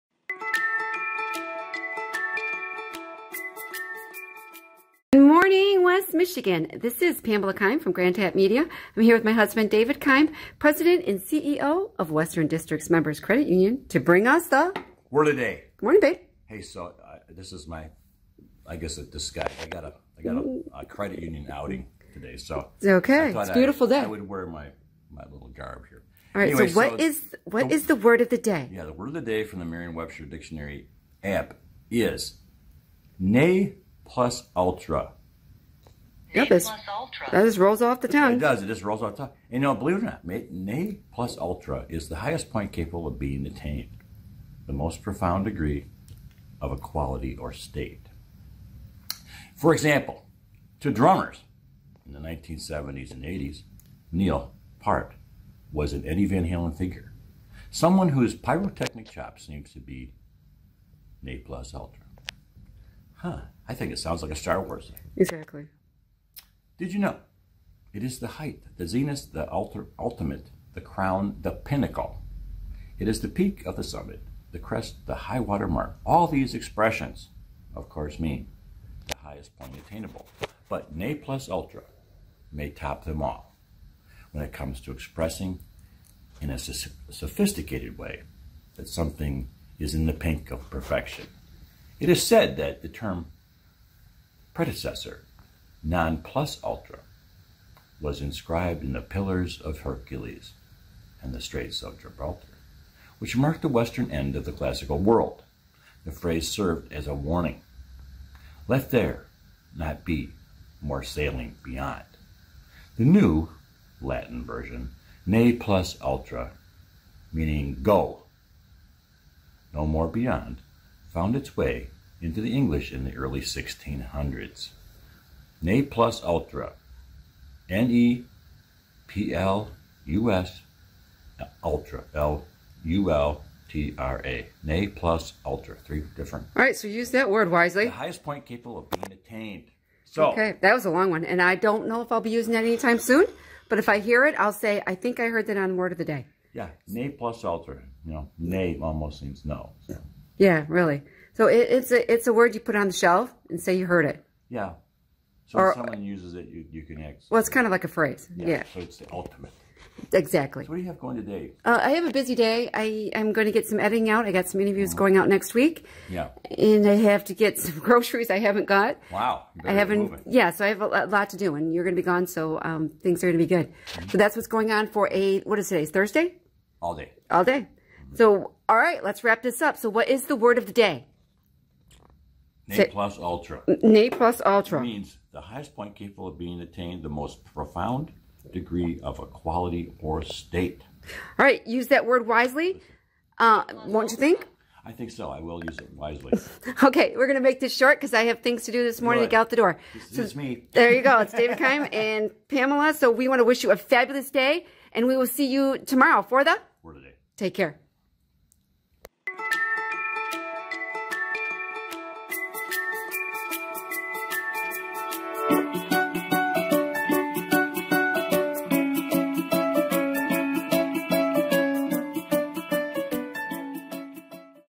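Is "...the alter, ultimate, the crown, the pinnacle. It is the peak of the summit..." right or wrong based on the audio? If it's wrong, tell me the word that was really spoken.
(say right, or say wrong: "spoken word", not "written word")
right.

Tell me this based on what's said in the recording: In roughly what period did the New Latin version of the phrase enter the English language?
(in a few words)
early 1600s.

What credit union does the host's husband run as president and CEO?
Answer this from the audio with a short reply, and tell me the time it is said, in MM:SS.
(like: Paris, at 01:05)
Western Districts Members Credit Union, at 00:12.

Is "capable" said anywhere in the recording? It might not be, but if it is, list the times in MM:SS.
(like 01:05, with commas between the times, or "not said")
00:42, 02:18, 03:05.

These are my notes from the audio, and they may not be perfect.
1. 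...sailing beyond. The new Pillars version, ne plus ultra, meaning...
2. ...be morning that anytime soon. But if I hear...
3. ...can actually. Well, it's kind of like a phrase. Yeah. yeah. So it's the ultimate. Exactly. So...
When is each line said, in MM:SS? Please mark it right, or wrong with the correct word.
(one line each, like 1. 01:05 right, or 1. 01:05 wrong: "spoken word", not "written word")
1. 01:51 wrong: "Latin", not "Pillars"
2. 02:22 wrong: "using", not "morning"
3. 02:36 right.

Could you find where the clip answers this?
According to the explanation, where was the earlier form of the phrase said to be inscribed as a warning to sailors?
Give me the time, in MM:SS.
01:39.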